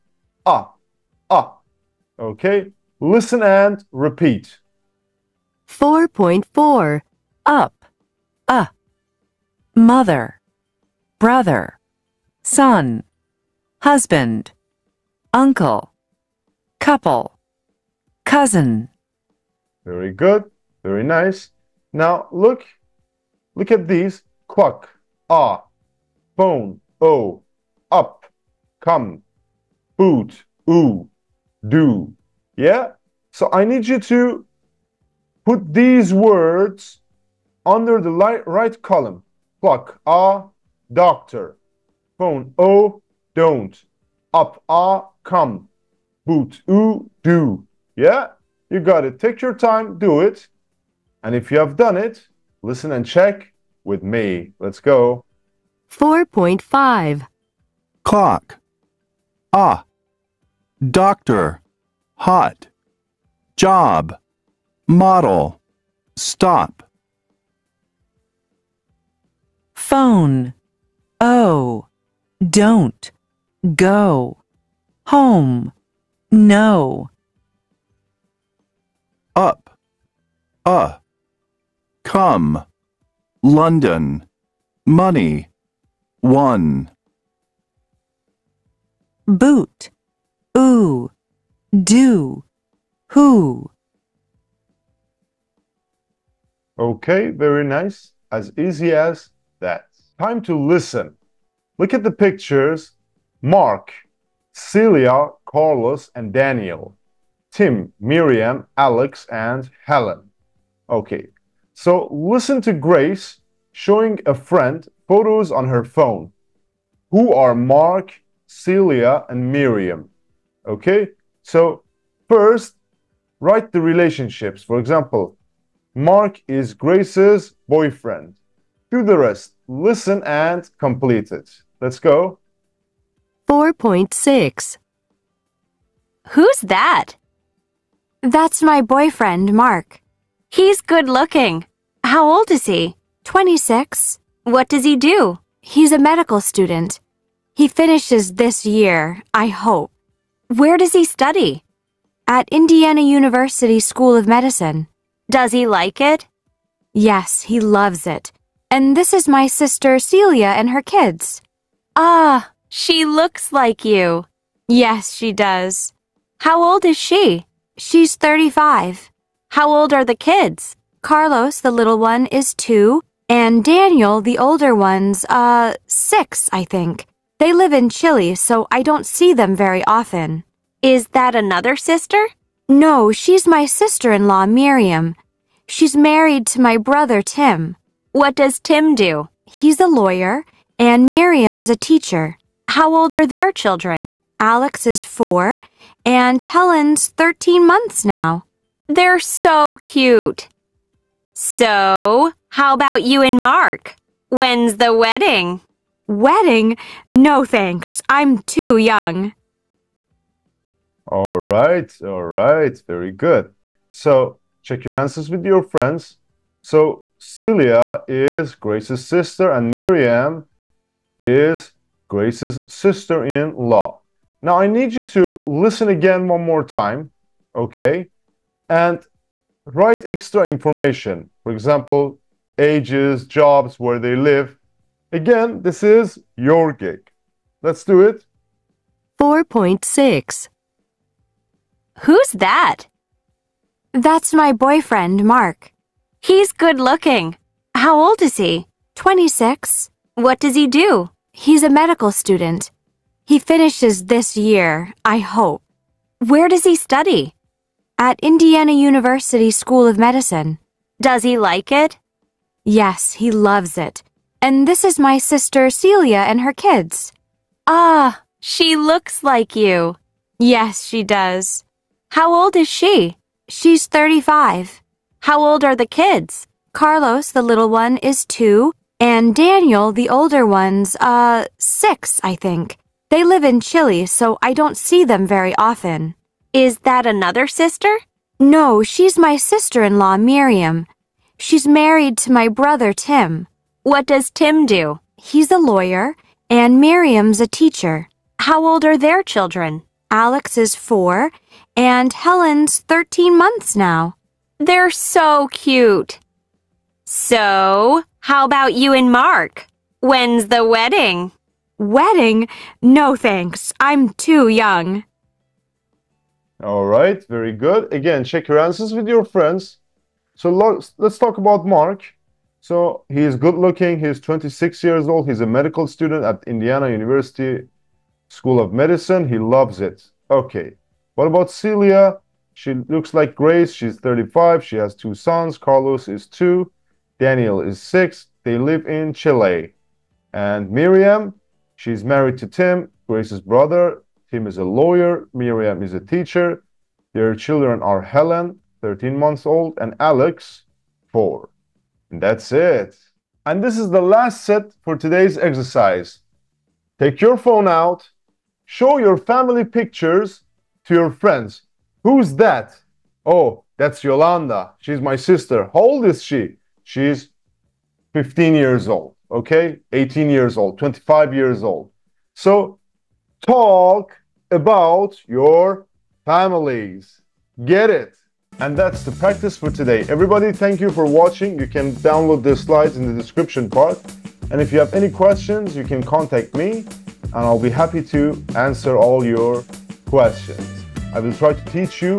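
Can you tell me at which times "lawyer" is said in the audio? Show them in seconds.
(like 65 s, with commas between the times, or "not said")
189 s, 295 s, 344 s.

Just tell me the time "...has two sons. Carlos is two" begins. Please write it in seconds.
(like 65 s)
334 s.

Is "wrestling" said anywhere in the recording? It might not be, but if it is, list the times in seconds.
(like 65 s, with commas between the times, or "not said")
not said.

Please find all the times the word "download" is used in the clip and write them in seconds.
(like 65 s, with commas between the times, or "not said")
381 s.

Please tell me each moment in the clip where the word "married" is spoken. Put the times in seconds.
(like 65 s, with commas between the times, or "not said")
185 s, 291 s, 342 s.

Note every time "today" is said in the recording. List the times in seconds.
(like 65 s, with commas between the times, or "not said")
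354 s, 379 s.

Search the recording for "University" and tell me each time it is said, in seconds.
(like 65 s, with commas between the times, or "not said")
153 s, 258 s, 326 s.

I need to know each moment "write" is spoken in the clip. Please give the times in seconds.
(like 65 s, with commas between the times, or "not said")
123 s, 229 s.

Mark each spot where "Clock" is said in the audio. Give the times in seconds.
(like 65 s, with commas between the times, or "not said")
58 s.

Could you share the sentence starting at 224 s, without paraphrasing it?
Now, I need you to listen again one more time, okay?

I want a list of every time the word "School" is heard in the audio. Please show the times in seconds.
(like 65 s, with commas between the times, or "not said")
153 s, 259 s, 328 s.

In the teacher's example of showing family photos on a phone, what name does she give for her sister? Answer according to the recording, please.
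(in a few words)
Yolanda.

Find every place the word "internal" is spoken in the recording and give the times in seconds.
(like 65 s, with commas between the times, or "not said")
not said.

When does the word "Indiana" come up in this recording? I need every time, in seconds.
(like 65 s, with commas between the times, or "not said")
152 s, 258 s, 326 s.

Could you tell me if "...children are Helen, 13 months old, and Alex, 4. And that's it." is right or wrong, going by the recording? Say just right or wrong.
right.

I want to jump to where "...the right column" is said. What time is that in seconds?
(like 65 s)
37 s.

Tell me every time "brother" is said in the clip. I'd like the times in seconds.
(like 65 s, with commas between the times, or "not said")
11 s, 186 s, 292 s, 343 s.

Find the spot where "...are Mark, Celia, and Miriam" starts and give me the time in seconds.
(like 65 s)
117 s.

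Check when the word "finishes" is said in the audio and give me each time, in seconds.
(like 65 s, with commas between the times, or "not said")
147 s, 253 s.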